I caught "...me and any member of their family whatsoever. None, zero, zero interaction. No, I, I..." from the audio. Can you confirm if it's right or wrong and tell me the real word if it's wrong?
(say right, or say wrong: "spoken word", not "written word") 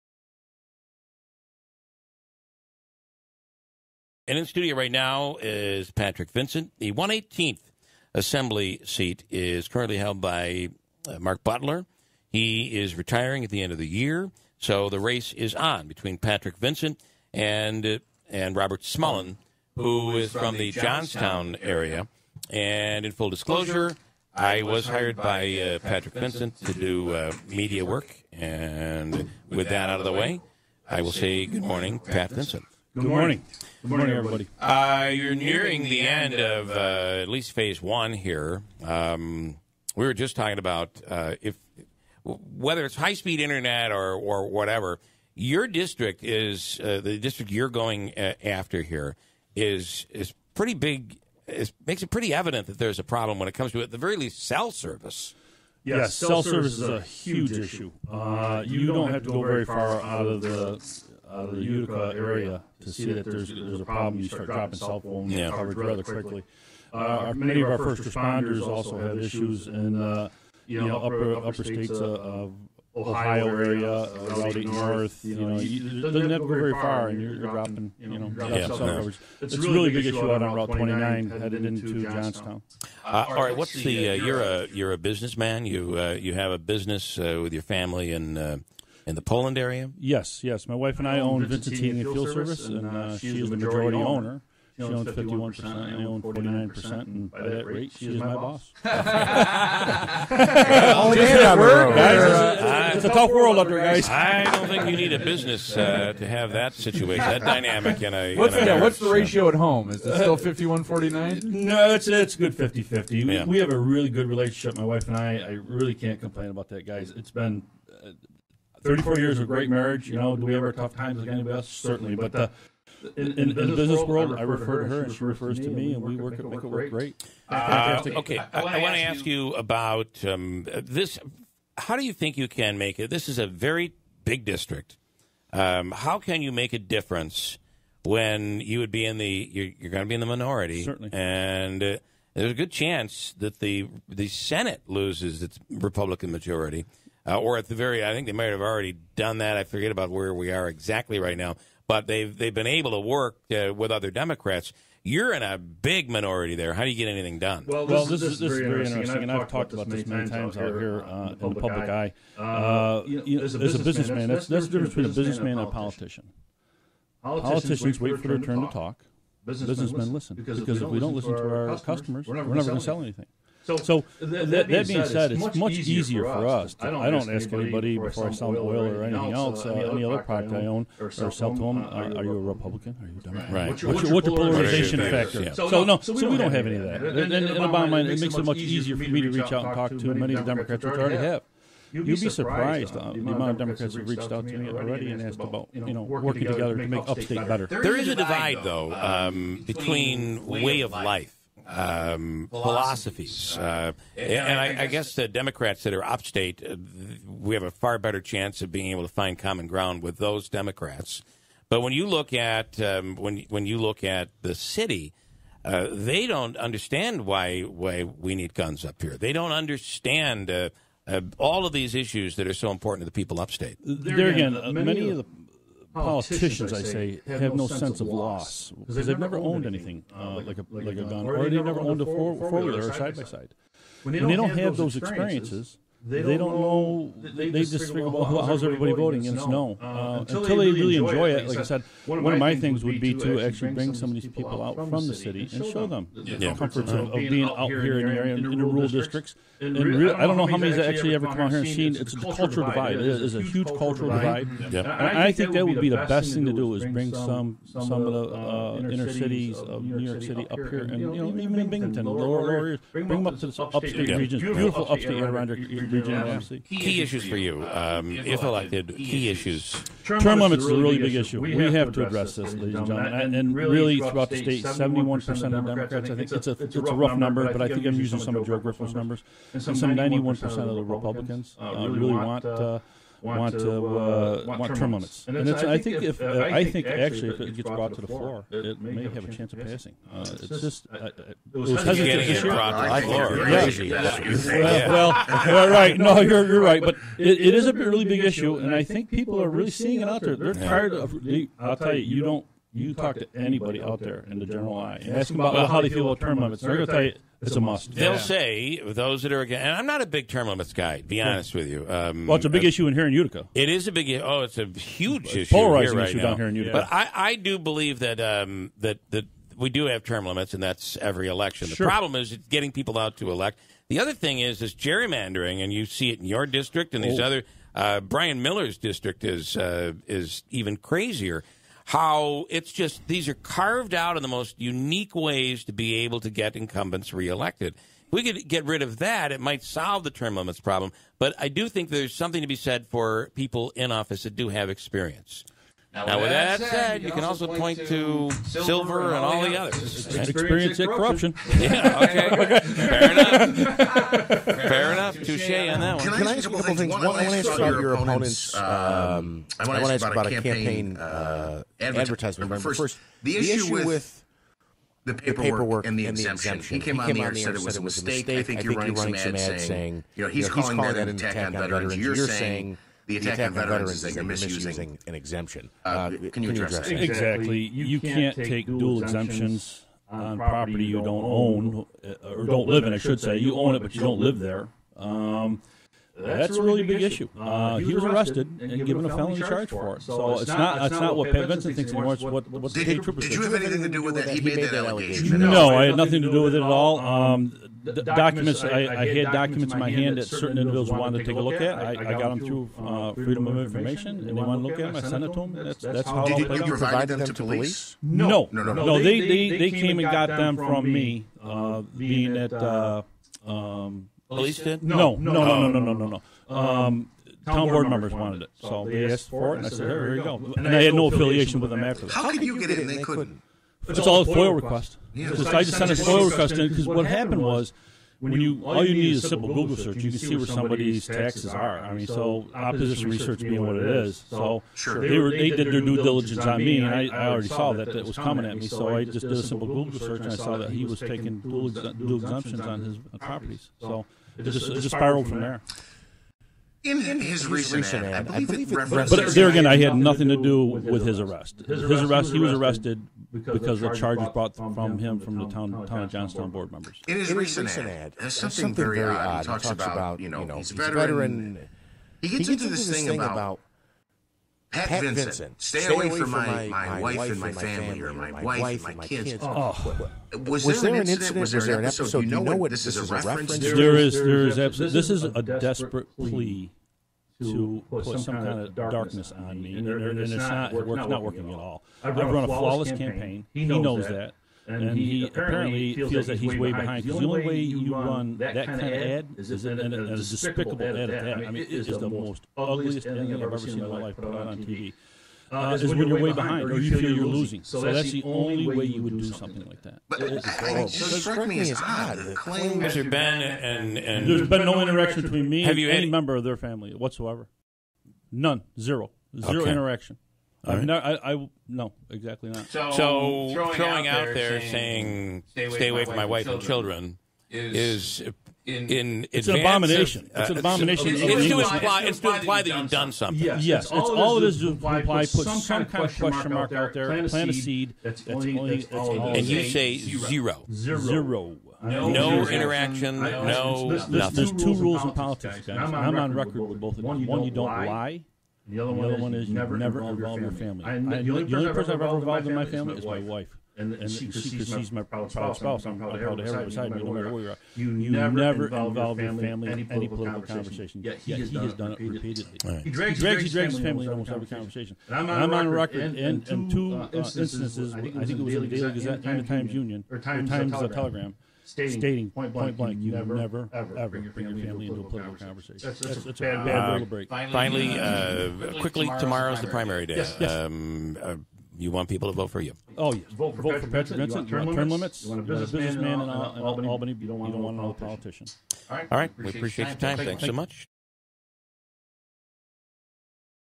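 right.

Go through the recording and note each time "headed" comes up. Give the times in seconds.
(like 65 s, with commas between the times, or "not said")
81 s.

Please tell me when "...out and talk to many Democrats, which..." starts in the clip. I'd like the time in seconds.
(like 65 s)
189 s.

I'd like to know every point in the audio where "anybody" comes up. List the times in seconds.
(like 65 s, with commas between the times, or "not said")
121 s, 177 s, 303 s.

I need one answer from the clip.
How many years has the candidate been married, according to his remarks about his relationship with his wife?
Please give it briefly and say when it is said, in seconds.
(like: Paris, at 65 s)
34 years, at 118 s.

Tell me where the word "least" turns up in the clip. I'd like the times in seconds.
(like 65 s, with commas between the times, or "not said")
37 s, 54 s.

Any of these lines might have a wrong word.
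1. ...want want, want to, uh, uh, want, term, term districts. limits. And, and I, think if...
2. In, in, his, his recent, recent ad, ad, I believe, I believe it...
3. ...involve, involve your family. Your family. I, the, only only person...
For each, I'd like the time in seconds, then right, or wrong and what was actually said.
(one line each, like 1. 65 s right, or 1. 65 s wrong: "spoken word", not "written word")
1. 282 s wrong: "limits", not "districts"
2. 446 s right
3. 539 s right.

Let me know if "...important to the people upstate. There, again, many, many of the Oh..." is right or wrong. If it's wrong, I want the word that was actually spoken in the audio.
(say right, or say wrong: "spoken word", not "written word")
right.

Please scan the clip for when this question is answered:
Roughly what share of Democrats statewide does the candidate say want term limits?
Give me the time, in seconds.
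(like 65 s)
274 s.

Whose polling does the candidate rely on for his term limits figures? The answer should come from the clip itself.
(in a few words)
Joe Griffin.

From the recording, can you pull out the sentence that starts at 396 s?
Um, um, the documents, I, I, had documents in my hand that certain individuals wanted to take a look at.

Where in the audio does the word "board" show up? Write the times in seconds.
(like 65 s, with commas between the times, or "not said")
417 s, 456 s.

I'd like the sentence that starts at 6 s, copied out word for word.
The 118th Assembly seat is currently held by uh, Marc Butler.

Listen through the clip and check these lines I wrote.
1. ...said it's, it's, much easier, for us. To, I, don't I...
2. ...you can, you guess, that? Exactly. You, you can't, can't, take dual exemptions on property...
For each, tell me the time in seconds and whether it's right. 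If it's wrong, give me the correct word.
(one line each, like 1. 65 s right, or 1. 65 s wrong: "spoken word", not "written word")
1. 175 s right
2. 376 s wrong: "address", not "guess".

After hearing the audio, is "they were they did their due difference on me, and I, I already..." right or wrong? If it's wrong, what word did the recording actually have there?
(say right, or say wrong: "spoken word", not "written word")
wrong: "diligence", not "difference".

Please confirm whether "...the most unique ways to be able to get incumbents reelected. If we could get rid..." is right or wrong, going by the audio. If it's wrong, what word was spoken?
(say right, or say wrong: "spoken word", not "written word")
right.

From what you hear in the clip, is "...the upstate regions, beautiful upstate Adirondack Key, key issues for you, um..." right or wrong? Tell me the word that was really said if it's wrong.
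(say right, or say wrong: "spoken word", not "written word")
right.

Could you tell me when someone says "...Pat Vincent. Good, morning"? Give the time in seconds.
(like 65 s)
31 s.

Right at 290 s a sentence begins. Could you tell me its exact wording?
it's just it was hesitant this year.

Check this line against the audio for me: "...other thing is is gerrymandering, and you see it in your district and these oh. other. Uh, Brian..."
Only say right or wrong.
right.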